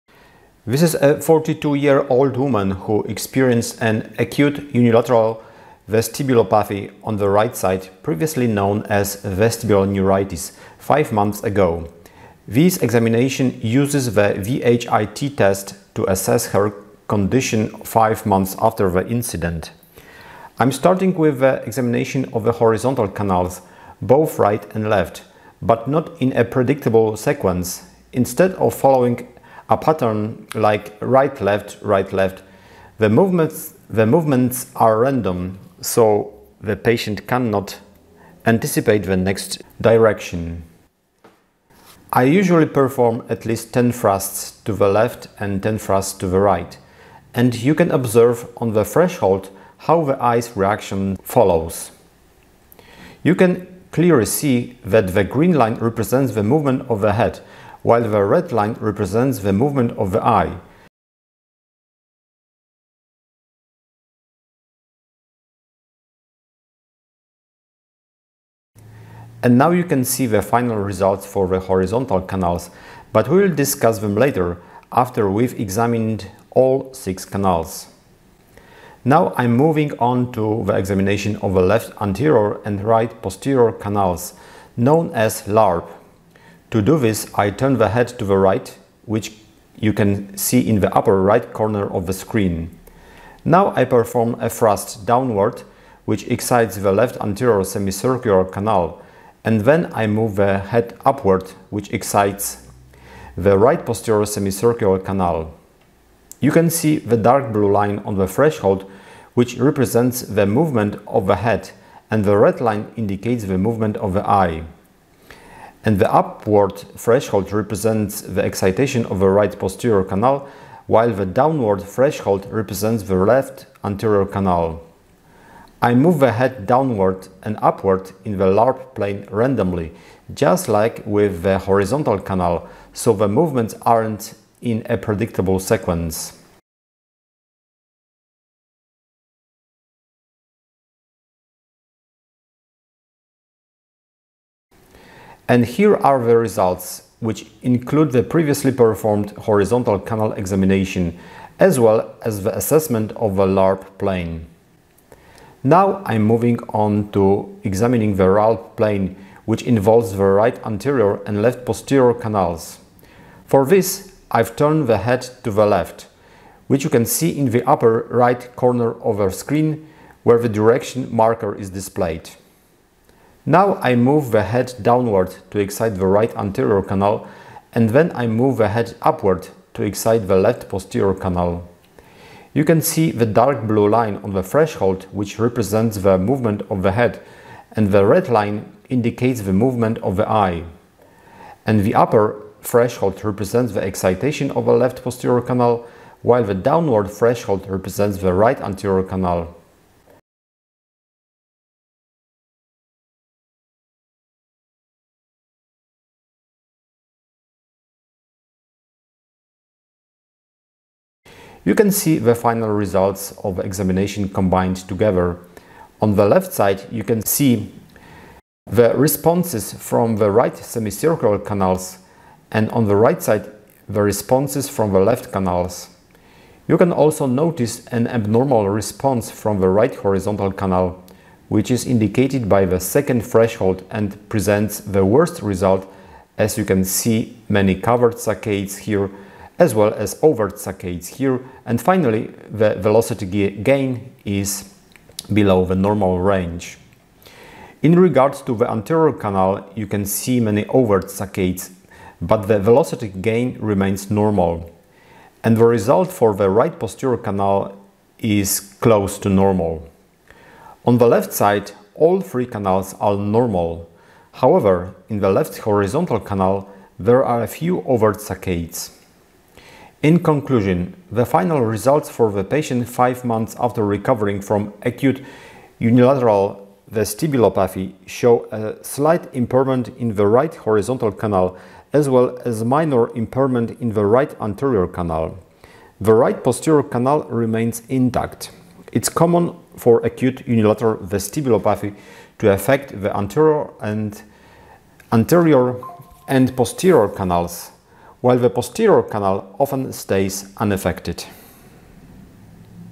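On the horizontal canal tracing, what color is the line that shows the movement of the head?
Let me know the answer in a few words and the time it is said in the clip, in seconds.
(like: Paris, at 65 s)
Green, at 55 s.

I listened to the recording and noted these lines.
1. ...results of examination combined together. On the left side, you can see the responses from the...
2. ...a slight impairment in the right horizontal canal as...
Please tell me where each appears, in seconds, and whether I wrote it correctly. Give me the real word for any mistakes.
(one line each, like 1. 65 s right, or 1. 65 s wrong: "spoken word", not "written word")
1. 212 s right
2. 278 s right.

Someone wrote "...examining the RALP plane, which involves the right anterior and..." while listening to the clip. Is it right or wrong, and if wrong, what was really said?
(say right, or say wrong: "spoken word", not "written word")
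right.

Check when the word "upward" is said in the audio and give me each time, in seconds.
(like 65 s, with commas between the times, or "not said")
101 s, 116 s, 127 s, 179 s.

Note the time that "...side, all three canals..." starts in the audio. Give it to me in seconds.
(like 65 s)
261 s.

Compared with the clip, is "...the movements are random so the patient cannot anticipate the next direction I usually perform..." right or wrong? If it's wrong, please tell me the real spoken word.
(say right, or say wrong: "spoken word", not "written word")
right.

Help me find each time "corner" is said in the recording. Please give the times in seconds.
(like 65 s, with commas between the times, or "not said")
91 s, 168 s.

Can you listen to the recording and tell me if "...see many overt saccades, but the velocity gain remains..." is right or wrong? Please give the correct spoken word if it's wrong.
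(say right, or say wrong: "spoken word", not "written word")
right.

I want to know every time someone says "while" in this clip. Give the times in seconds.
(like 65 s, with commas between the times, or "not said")
57 s, 120 s, 196 s, 298 s.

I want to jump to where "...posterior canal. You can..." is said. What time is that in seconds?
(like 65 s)
180 s.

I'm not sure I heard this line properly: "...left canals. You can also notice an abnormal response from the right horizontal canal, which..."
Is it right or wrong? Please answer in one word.
right.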